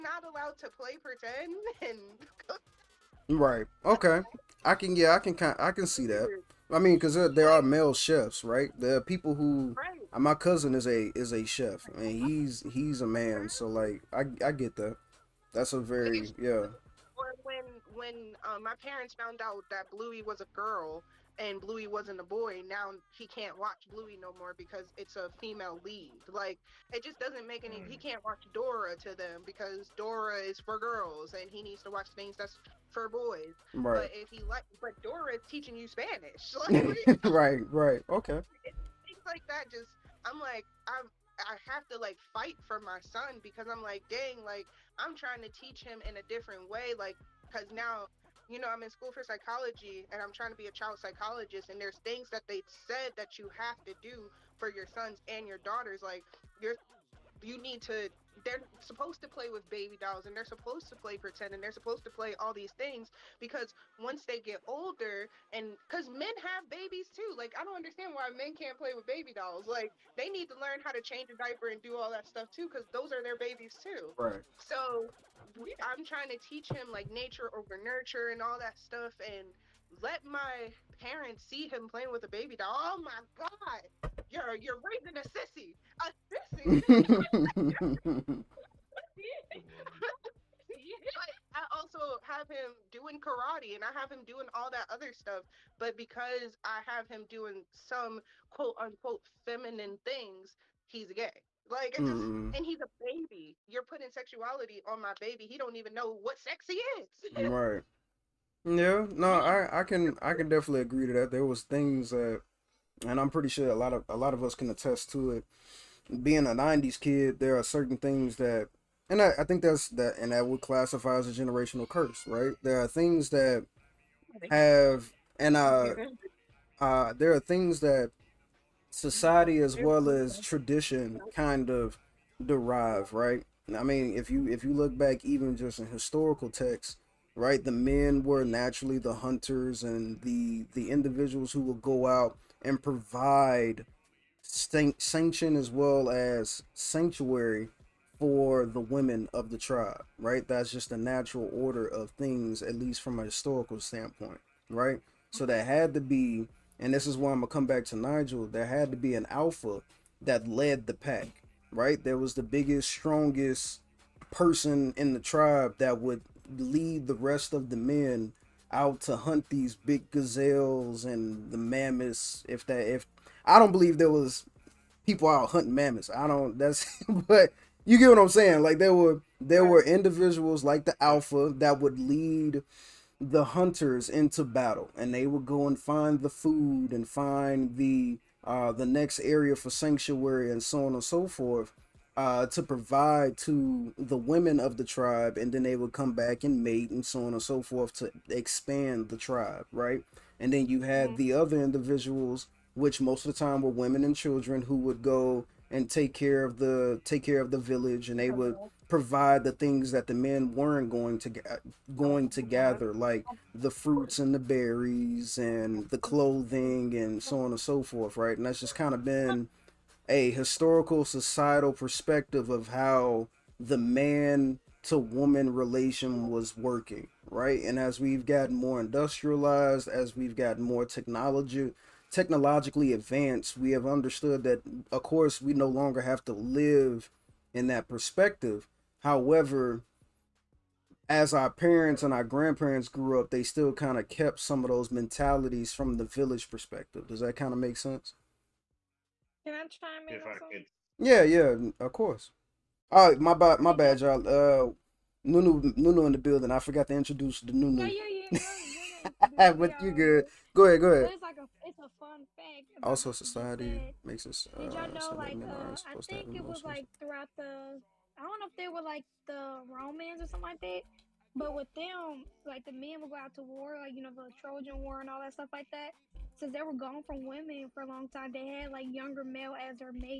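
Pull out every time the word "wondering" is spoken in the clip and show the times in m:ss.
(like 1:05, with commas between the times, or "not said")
not said.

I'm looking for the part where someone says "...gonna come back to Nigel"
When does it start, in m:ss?
2:37.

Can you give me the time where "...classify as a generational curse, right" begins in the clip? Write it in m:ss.
2:00.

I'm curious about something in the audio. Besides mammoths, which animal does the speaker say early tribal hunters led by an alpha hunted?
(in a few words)
gazelles.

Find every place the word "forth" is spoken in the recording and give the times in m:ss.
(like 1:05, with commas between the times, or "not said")
3:11, 3:17, 3:37.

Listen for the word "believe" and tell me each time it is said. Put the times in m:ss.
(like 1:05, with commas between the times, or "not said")
2:53.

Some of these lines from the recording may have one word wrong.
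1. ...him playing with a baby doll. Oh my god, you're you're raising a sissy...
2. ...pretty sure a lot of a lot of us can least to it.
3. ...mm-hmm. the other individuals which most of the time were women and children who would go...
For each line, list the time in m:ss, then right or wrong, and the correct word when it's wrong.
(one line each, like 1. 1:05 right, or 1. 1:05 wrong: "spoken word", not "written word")
1. 1:21 right
2. 1:53 wrong: "attest", not "least"
3. 3:21 right.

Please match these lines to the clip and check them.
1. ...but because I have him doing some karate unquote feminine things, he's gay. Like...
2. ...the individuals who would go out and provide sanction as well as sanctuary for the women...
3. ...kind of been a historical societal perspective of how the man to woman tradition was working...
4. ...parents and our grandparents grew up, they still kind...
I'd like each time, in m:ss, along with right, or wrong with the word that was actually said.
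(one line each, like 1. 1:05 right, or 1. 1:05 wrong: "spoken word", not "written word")
1. 1:35 wrong: "quote", not "karate"
2. 2:20 right
3. 3:38 wrong: "relation", not "tradition"
4. 4:01 right.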